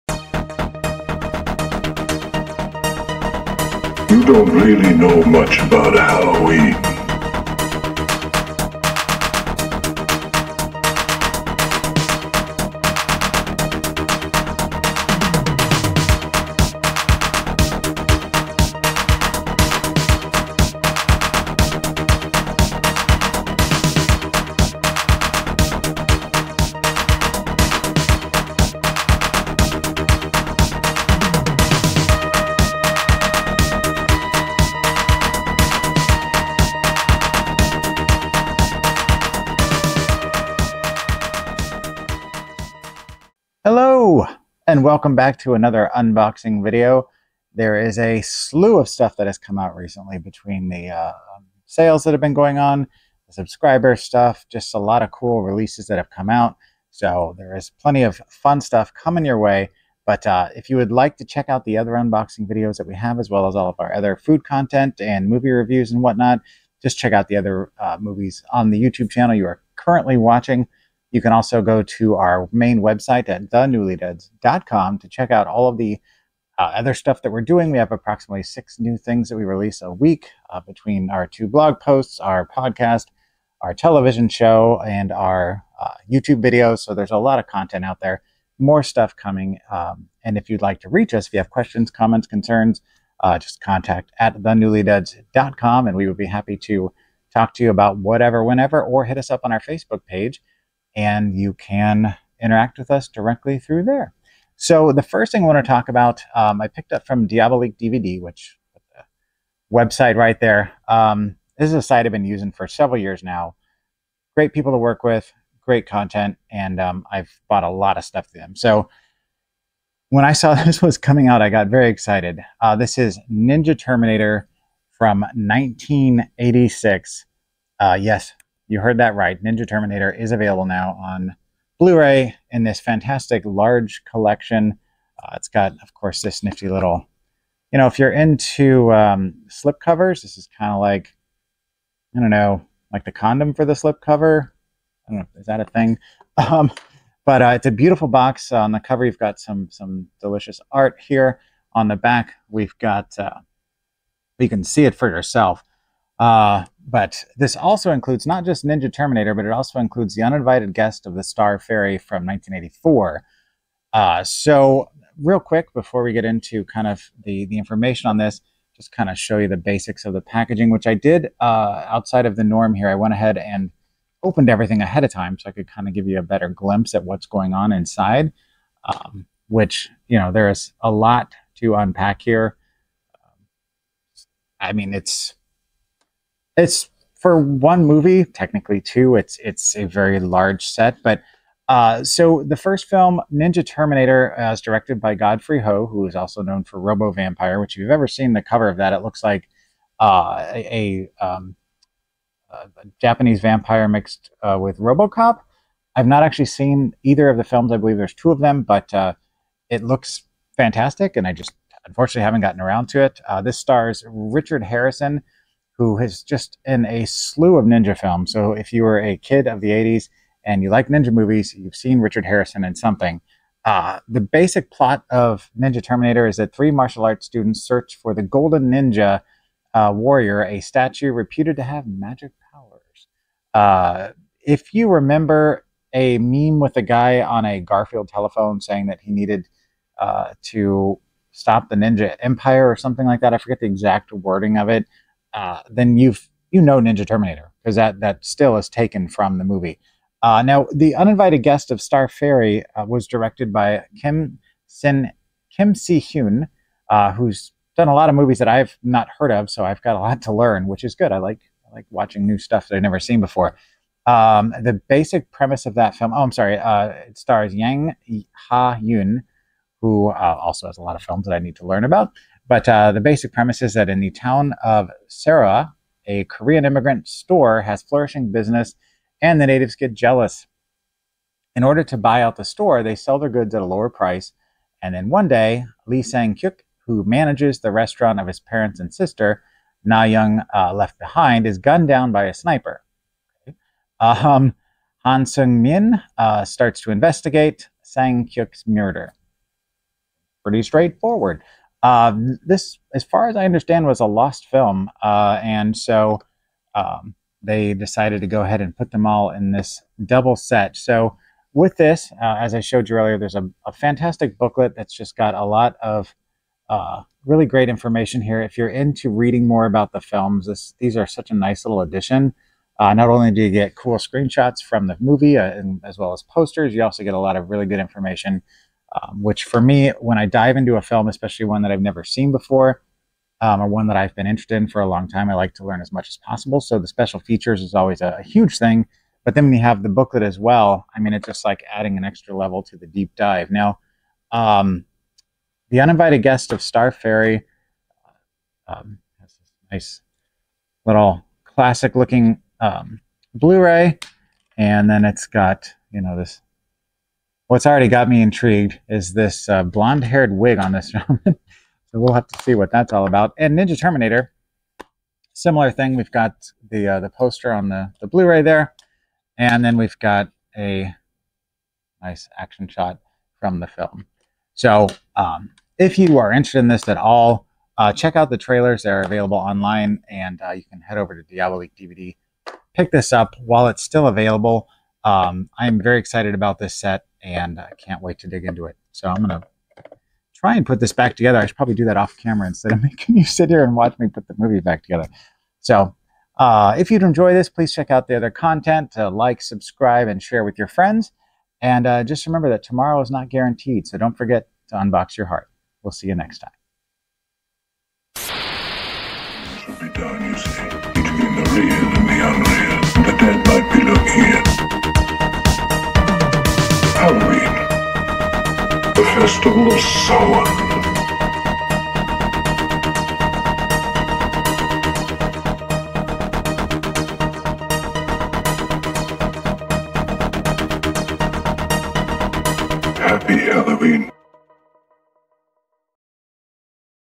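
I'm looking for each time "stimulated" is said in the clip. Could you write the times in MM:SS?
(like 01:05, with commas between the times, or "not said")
not said.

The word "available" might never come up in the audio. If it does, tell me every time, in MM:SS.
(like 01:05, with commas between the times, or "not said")
02:10, 06:19, 06:24.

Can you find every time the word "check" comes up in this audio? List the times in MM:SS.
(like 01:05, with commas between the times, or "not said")
01:01, 01:06, 01:15, 06:17, 06:37.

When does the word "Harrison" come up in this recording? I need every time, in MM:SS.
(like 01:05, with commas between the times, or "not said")
03:34, 03:42.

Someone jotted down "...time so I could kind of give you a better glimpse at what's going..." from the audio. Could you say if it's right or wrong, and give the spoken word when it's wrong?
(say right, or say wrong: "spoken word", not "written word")
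right.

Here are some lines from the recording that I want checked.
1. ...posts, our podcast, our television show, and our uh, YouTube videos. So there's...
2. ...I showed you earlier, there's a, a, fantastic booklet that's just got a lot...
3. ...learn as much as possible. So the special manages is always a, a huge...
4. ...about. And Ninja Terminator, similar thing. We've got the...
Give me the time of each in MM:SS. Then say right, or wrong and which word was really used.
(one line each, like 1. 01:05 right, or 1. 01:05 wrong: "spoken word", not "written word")
1. 01:21 right
2. 05:12 right
3. 05:35 wrong: "features", not "manages"
4. 06:03 right.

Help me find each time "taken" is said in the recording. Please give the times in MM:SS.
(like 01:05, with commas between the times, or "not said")
04:08.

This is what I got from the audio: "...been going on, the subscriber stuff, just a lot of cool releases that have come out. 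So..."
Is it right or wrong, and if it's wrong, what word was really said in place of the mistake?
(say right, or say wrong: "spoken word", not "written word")
right.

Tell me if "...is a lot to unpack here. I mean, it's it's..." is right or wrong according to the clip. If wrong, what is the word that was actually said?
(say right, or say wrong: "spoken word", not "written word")
right.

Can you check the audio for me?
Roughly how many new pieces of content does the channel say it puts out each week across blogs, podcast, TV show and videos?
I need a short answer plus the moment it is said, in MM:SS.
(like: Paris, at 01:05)
6, at 01:18.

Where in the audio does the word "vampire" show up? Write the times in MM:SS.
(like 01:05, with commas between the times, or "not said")
03:17, 03:23.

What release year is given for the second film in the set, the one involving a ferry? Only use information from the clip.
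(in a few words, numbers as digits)
1984.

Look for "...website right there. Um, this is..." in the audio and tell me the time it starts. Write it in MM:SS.
01:49.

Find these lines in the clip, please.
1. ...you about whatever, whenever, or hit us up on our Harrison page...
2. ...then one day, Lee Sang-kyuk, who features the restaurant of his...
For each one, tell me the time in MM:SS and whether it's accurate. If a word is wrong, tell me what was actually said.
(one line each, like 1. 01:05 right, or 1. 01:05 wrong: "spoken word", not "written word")
1. 01:37 wrong: "Facebook", not "Harrison"
2. 04:44 wrong: "manages", not "features".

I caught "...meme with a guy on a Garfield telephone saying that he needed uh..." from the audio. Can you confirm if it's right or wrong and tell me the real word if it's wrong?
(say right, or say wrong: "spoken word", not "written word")
right.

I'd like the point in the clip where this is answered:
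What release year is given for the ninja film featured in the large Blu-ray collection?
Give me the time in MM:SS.
02:05.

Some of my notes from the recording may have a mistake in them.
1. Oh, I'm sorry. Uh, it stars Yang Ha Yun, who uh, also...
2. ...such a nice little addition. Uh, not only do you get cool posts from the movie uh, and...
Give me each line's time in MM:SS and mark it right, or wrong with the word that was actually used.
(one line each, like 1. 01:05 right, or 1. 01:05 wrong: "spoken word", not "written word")
1. 04:26 right
2. 05:21 wrong: "screenshots", not "posts".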